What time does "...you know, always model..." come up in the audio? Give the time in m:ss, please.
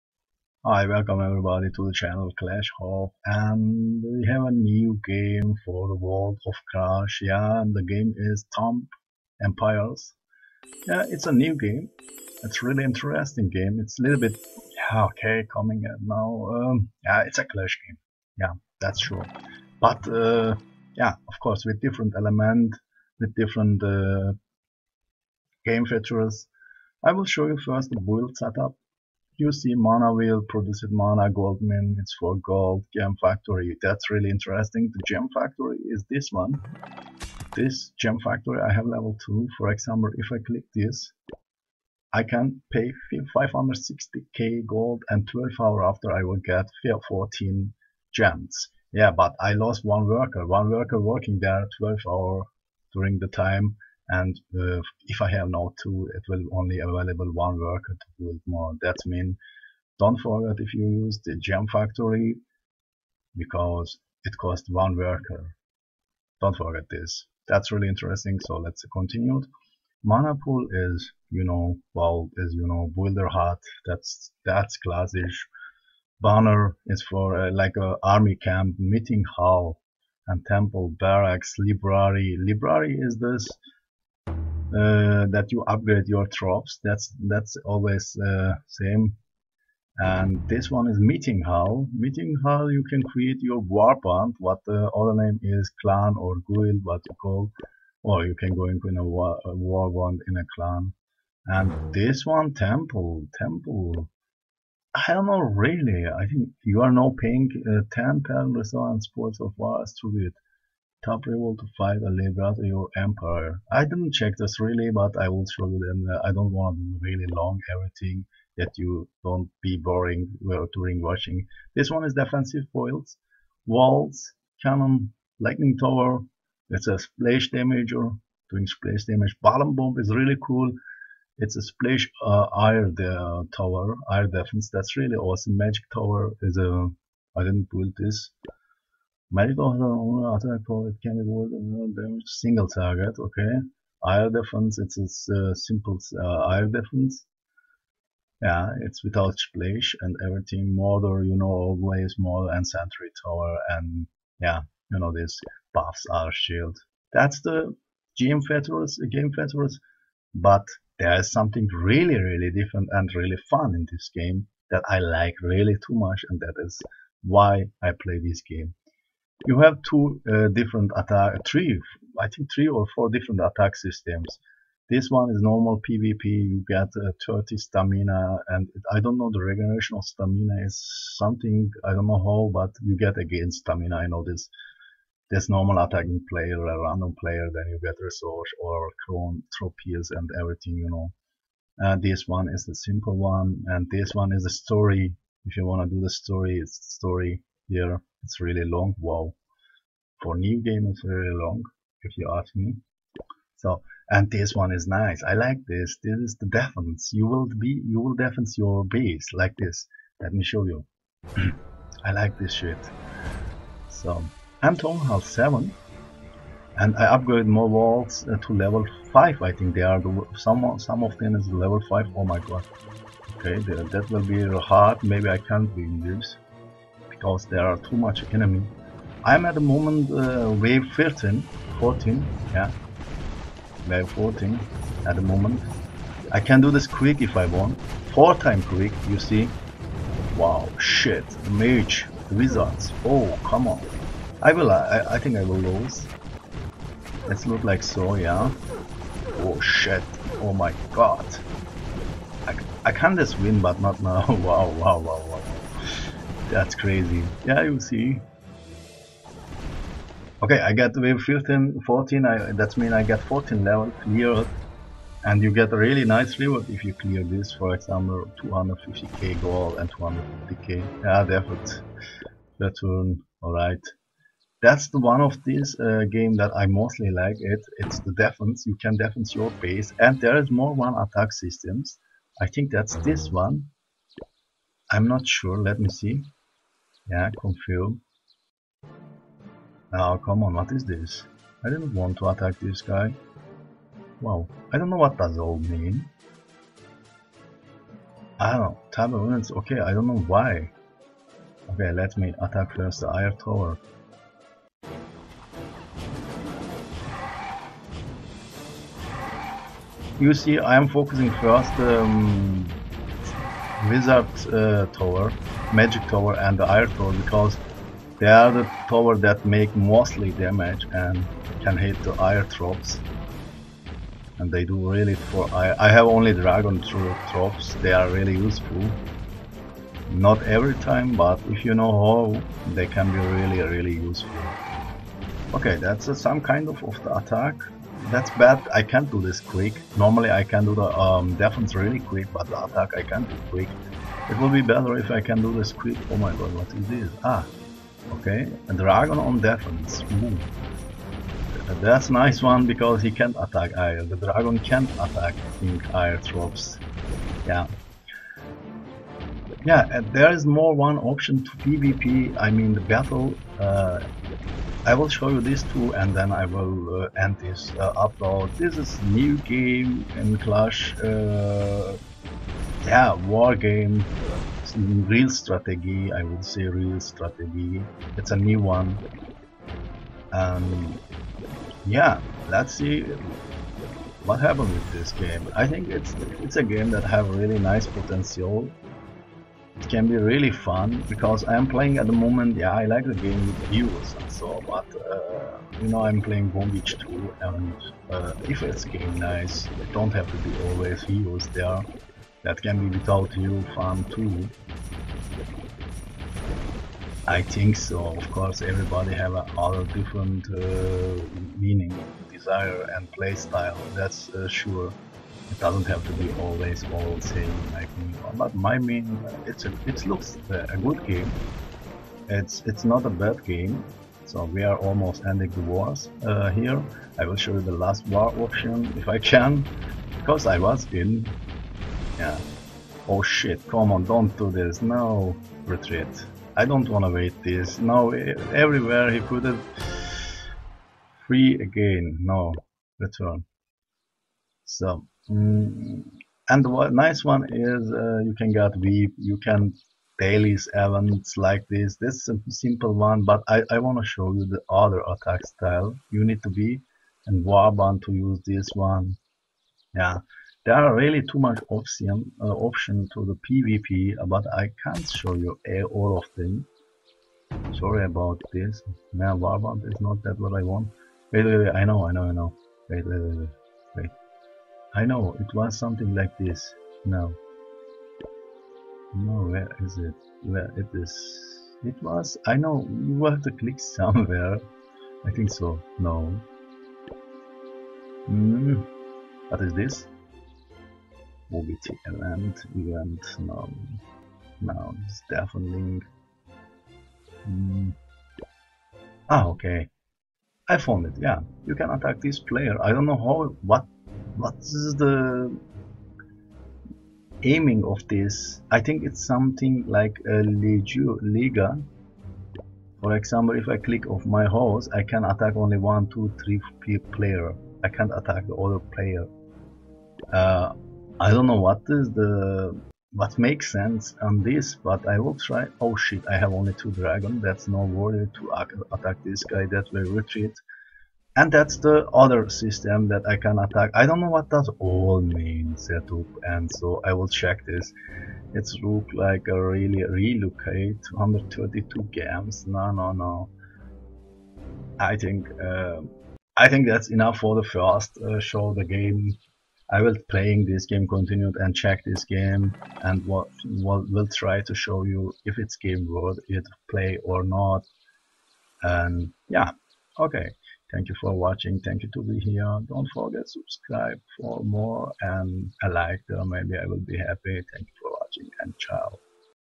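2:31.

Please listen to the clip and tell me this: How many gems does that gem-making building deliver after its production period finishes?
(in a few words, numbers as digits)
14.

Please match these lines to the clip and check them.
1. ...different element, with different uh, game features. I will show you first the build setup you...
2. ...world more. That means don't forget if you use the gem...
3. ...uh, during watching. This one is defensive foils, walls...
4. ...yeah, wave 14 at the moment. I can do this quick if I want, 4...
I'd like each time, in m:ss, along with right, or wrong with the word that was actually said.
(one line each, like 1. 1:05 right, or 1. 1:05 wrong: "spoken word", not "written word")
1. 0:21 right
2. 0:58 wrong: "build", not "world"
3. 2:00 right
4. 3:52 right.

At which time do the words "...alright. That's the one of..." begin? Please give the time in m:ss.
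4:33.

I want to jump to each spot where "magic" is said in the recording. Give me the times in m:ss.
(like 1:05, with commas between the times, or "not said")
2:15, 5:15.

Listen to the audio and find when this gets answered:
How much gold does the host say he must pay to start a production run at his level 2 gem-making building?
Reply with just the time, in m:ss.
0:43.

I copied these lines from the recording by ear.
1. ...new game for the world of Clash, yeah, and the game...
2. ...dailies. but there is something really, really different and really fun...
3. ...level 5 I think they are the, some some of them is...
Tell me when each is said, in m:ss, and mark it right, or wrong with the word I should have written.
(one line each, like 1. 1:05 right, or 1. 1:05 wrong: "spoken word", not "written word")
1. 0:04 right
2. 2:39 wrong: "features", not "dailies"
3. 3:38 right.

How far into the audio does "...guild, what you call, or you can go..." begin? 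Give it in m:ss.
1:36.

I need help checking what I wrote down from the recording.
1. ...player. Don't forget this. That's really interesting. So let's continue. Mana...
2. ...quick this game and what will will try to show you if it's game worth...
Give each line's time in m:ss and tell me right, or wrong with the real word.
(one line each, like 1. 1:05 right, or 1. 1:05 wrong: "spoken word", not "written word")
1. 1:04 wrong: "worker", not "player"
2. 9:11 wrong: "check", not "quick".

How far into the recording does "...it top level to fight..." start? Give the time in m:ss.
1:50.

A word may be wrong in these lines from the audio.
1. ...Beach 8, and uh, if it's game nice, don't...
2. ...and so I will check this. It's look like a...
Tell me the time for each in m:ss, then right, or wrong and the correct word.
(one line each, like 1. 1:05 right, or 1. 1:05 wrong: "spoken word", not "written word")
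1. 6:36 wrong: "2", not "8"
2. 8:56 right.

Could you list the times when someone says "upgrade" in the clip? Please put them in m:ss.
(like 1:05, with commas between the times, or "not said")
1:25, 3:37.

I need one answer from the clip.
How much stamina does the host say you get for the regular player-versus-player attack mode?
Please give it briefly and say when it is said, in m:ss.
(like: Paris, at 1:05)
30, at 2:57.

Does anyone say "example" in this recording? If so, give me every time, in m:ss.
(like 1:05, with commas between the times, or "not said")
0:39, 4:27, 8:33.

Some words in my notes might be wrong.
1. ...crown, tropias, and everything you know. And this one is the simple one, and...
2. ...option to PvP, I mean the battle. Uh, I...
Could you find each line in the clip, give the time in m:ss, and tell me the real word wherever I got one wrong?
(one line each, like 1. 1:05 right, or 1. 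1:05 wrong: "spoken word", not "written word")
1. 3:09 right
2. 6:00 right.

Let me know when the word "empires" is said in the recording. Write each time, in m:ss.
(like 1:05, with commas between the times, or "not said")
0:09, 1:52.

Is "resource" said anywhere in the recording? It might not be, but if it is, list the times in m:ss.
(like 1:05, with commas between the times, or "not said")
1:48, 3:08.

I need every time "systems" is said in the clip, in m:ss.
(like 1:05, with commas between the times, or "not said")
2:53, 4:41, 8:52.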